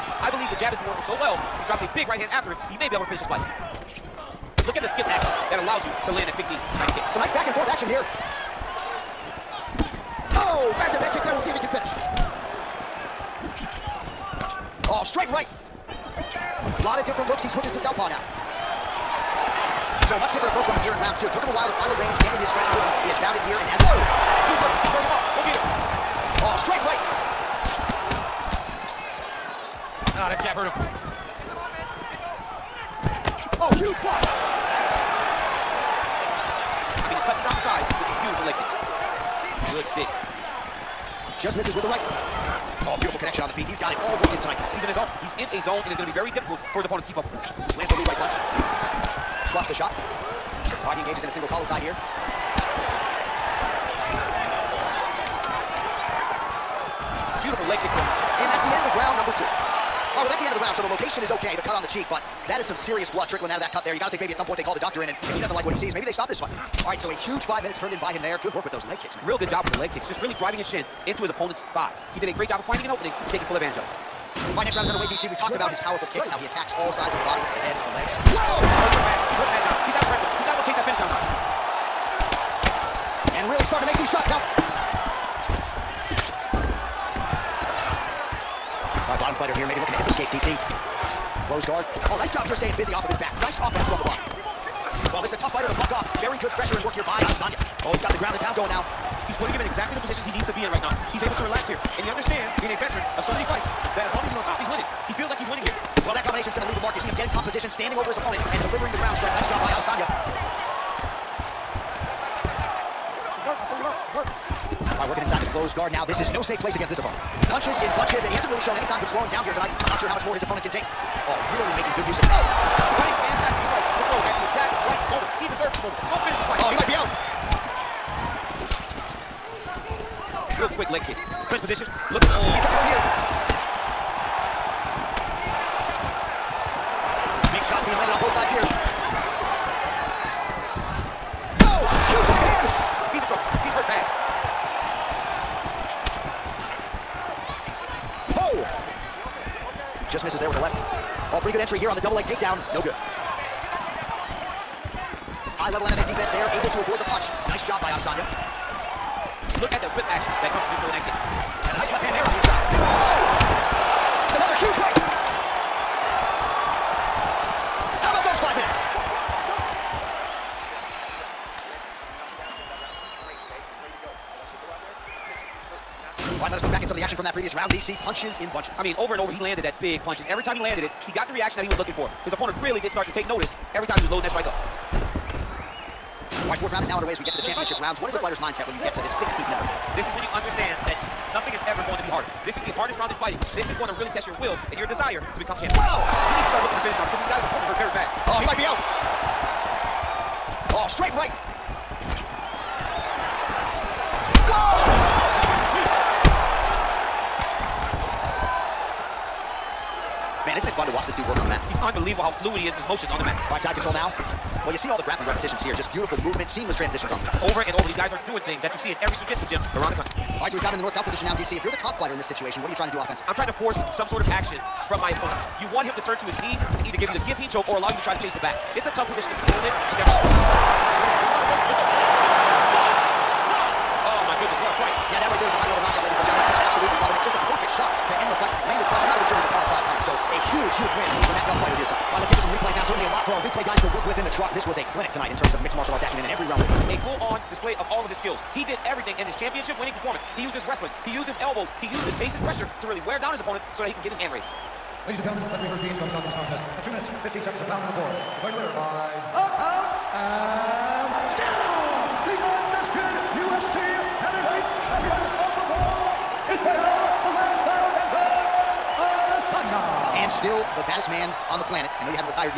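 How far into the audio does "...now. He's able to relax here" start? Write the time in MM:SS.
01:40.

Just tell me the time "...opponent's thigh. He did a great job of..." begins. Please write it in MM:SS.
01:11.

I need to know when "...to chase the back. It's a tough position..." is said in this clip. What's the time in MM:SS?
03:48.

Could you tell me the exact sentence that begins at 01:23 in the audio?
And really starting to make these shots count.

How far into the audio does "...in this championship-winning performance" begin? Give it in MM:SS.
04:09.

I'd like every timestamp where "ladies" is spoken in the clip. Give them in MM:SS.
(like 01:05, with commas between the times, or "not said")
03:56, 04:15.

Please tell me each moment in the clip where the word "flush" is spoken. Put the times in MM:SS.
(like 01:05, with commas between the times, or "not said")
03:58.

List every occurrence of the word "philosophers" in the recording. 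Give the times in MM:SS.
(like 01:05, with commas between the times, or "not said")
not said.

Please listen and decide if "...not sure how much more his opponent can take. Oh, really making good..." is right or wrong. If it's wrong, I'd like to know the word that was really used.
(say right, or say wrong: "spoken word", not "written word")
right.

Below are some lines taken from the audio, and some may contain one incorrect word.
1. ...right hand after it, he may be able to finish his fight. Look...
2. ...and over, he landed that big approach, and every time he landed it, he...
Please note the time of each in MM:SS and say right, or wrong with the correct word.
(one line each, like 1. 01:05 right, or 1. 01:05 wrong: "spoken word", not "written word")
1. 00:02 right
2. 02:59 wrong: "punch", not "approach".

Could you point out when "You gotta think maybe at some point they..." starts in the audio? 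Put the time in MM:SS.
01:03.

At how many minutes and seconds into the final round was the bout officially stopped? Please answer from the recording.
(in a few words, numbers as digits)
2:15.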